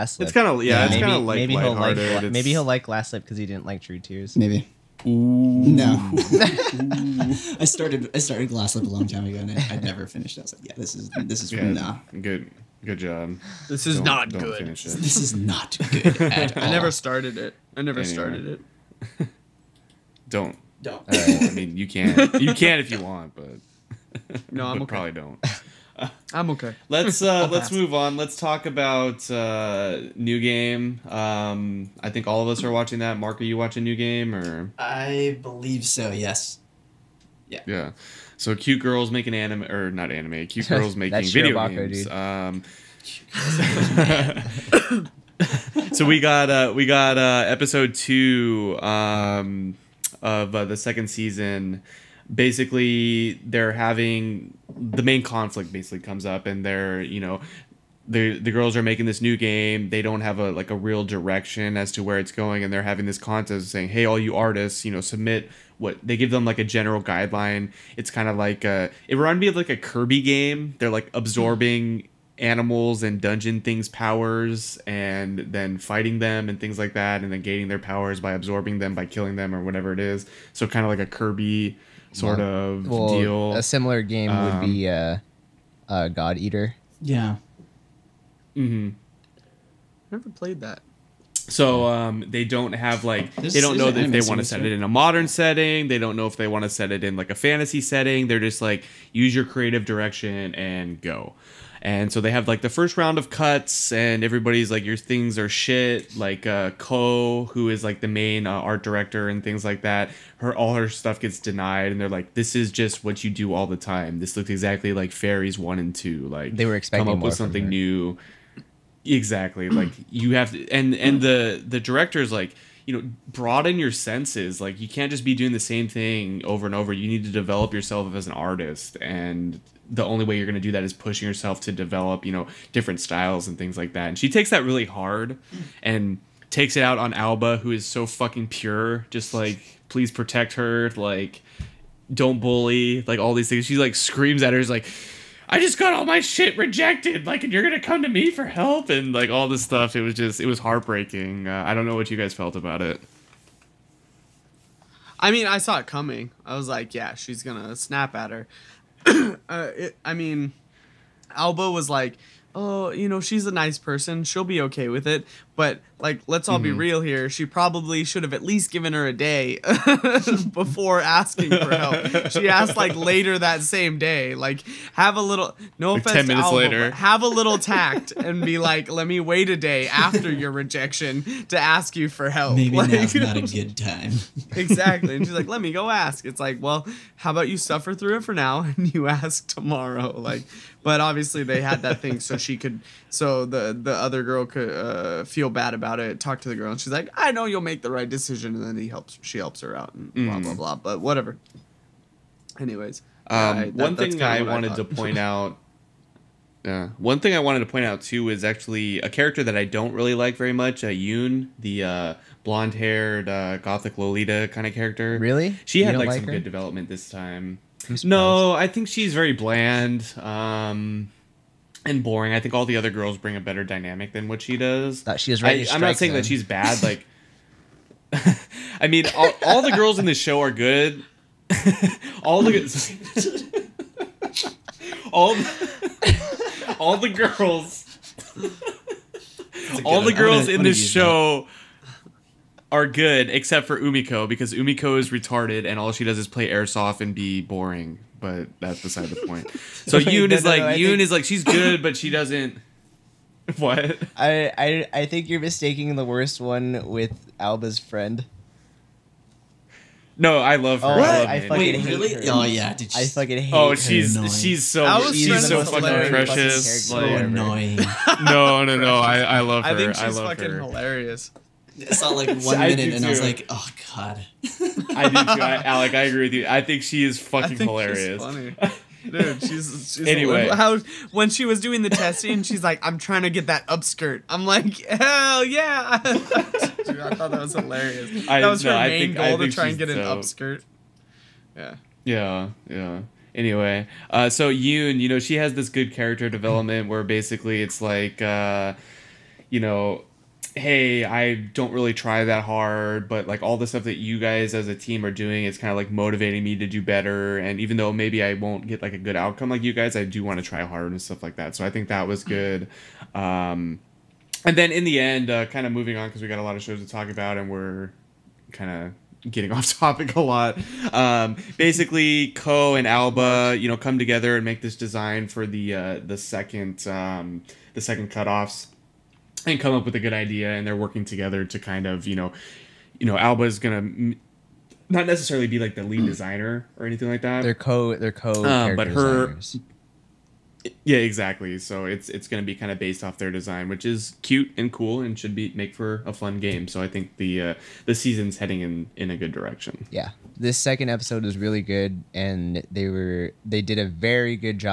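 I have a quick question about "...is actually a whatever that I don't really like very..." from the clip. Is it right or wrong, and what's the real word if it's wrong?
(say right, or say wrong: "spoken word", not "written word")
wrong: "character", not "whatever".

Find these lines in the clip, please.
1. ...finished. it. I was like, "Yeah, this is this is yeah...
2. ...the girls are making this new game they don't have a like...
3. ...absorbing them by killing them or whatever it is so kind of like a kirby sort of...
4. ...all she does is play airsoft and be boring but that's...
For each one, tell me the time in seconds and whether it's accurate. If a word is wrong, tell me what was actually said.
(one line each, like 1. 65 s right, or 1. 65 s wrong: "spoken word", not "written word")
1. 10 s right
2. 58 s right
3. 78 s right
4. 245 s right.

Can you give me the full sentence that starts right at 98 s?
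They're just like use your creative direction and go.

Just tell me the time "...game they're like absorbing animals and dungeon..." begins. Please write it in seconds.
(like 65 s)
70 s.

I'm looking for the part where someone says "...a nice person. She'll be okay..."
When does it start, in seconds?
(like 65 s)
163 s.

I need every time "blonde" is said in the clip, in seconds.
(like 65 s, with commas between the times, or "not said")
212 s.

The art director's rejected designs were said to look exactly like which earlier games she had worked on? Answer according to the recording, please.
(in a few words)
Fairies One and Two.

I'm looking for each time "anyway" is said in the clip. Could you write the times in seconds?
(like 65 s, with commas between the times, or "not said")
18 s, 202 s, 280 s, 293 s.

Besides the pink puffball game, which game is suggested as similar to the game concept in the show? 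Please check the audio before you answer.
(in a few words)
God Eater.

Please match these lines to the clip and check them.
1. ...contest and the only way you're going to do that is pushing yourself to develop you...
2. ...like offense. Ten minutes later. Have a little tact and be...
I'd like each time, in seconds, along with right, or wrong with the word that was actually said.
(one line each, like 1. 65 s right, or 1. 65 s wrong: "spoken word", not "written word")
1. 128 s wrong: "artist", not "contest"
2. 175 s right.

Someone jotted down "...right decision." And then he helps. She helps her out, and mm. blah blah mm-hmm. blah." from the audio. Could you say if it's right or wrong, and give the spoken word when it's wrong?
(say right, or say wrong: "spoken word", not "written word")
right.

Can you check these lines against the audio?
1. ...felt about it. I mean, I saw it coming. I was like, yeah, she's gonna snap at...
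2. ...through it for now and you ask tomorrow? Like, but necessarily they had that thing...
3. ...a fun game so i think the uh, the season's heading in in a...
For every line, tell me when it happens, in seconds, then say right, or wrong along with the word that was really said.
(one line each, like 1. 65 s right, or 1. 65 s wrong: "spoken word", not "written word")
1. 152 s right
2. 187 s wrong: "obviously", not "necessarily"
3. 346 s right.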